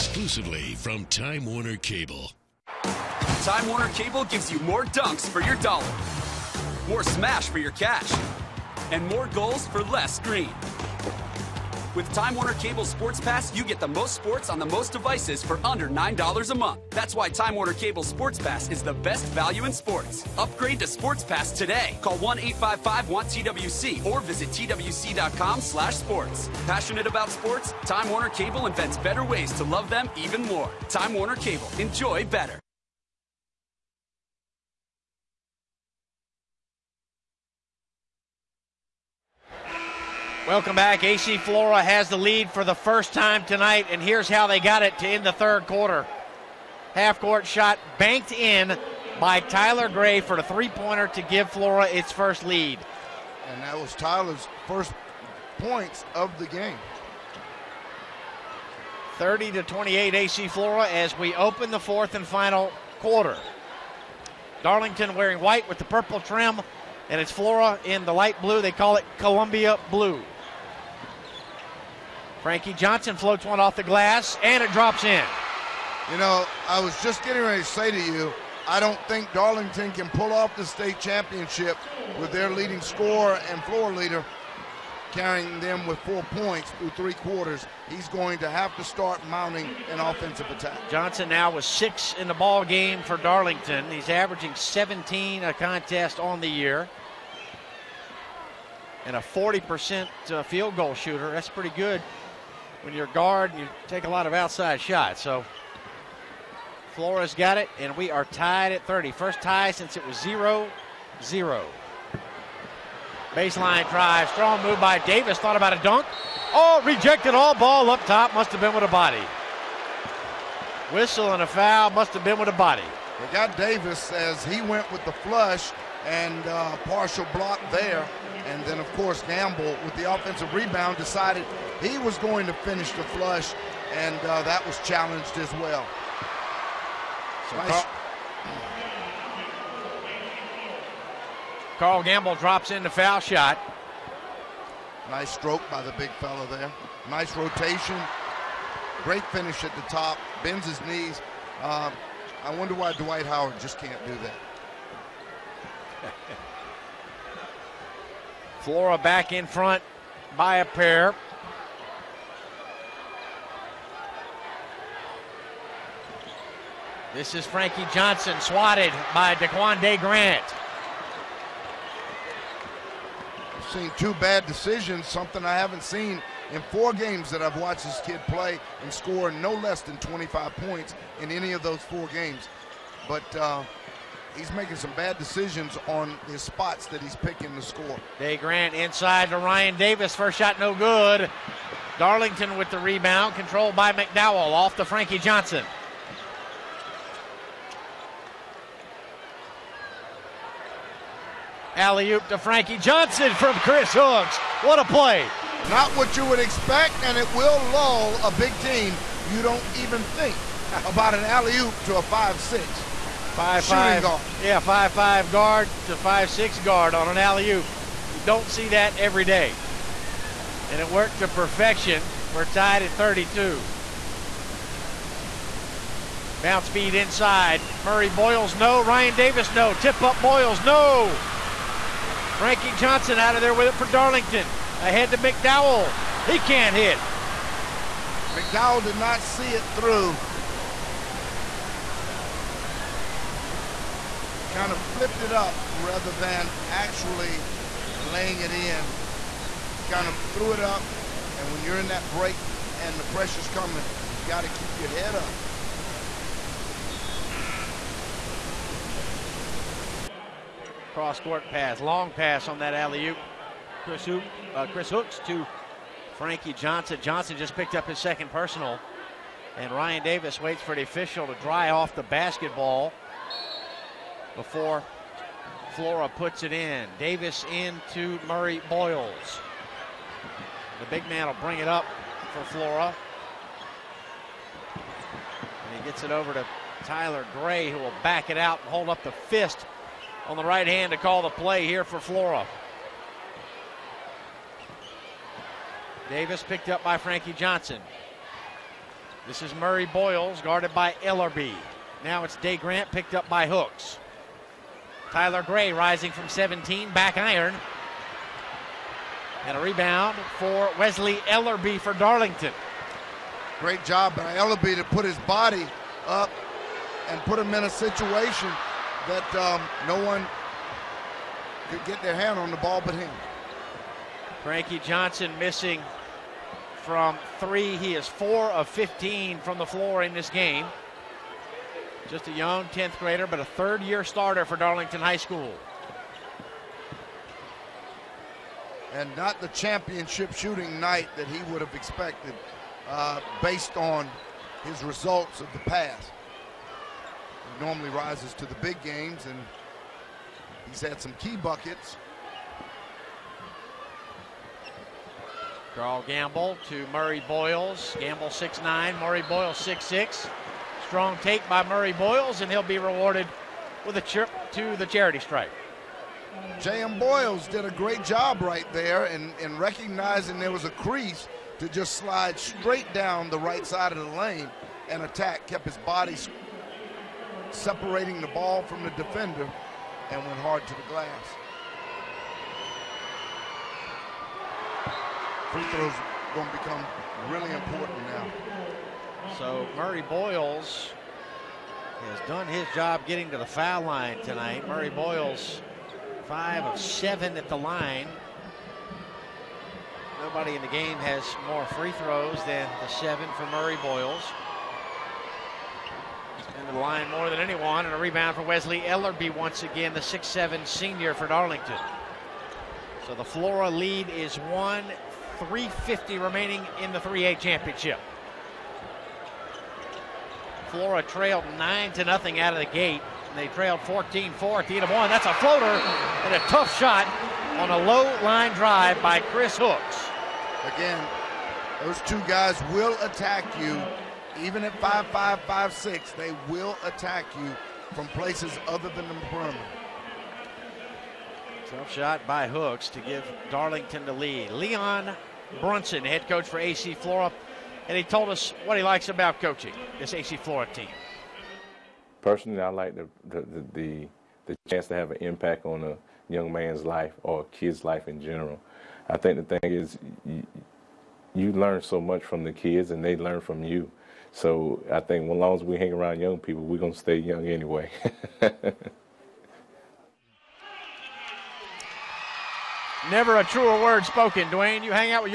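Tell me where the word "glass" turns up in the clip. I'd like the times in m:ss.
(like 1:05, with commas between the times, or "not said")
1:13, 6:20.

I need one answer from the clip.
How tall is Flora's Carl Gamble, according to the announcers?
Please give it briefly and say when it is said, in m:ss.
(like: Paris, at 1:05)
6'9, at 5:58.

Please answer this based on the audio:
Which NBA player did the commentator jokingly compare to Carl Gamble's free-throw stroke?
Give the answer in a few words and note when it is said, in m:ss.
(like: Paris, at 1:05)
Dwight Howard, at 2:32.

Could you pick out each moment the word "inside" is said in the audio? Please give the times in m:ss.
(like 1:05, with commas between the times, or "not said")
3:08, 3:46.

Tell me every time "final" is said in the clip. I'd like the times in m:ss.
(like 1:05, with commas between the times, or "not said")
1:02.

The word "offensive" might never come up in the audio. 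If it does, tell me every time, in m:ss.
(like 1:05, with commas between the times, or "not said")
1:29, 2:10.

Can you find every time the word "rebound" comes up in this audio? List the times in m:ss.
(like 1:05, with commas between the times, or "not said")
2:10, 3:12, 5:09, 6:47.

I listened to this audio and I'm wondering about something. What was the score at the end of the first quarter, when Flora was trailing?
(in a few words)
14-4.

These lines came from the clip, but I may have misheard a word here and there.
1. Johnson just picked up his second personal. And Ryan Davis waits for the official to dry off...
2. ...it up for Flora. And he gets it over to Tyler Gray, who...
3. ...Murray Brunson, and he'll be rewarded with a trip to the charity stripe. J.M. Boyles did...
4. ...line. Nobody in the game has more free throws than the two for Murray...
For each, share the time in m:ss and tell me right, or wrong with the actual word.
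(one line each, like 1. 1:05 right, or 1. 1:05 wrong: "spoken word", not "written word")
1. 4:27 right
2. 4:41 right
3. 6:01 wrong: "Boyles", not "Brunson"
4. 6:37 wrong: "seven", not "two".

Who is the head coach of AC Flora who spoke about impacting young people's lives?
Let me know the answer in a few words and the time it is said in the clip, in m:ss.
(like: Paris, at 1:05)
Leon Brunson, at 7:24.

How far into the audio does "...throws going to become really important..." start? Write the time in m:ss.
6:25.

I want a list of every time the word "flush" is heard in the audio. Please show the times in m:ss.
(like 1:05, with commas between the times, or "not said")
2:05, 2:13.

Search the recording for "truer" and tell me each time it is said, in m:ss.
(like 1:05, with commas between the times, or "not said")
7:53.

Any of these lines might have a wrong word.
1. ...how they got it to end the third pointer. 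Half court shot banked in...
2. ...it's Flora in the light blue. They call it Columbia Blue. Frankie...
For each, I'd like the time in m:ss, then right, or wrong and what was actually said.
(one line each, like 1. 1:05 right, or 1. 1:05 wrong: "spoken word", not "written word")
1. 0:44 wrong: "quarter", not "pointer"
2. 1:07 right.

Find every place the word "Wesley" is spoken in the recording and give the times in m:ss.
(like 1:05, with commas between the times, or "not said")
5:10, 6:48.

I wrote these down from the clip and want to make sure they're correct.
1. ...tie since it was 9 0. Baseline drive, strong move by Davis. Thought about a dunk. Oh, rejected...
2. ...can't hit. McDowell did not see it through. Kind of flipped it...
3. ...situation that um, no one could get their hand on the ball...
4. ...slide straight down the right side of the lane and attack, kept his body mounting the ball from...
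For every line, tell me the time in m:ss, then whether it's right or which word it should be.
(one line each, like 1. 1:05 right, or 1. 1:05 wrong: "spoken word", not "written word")
1. 1:49 wrong: "0", not "9"
2. 3:56 right
3. 5:17 right
4. 6:11 wrong: "separating", not "mounting".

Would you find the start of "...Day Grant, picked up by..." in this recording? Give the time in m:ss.
5:02.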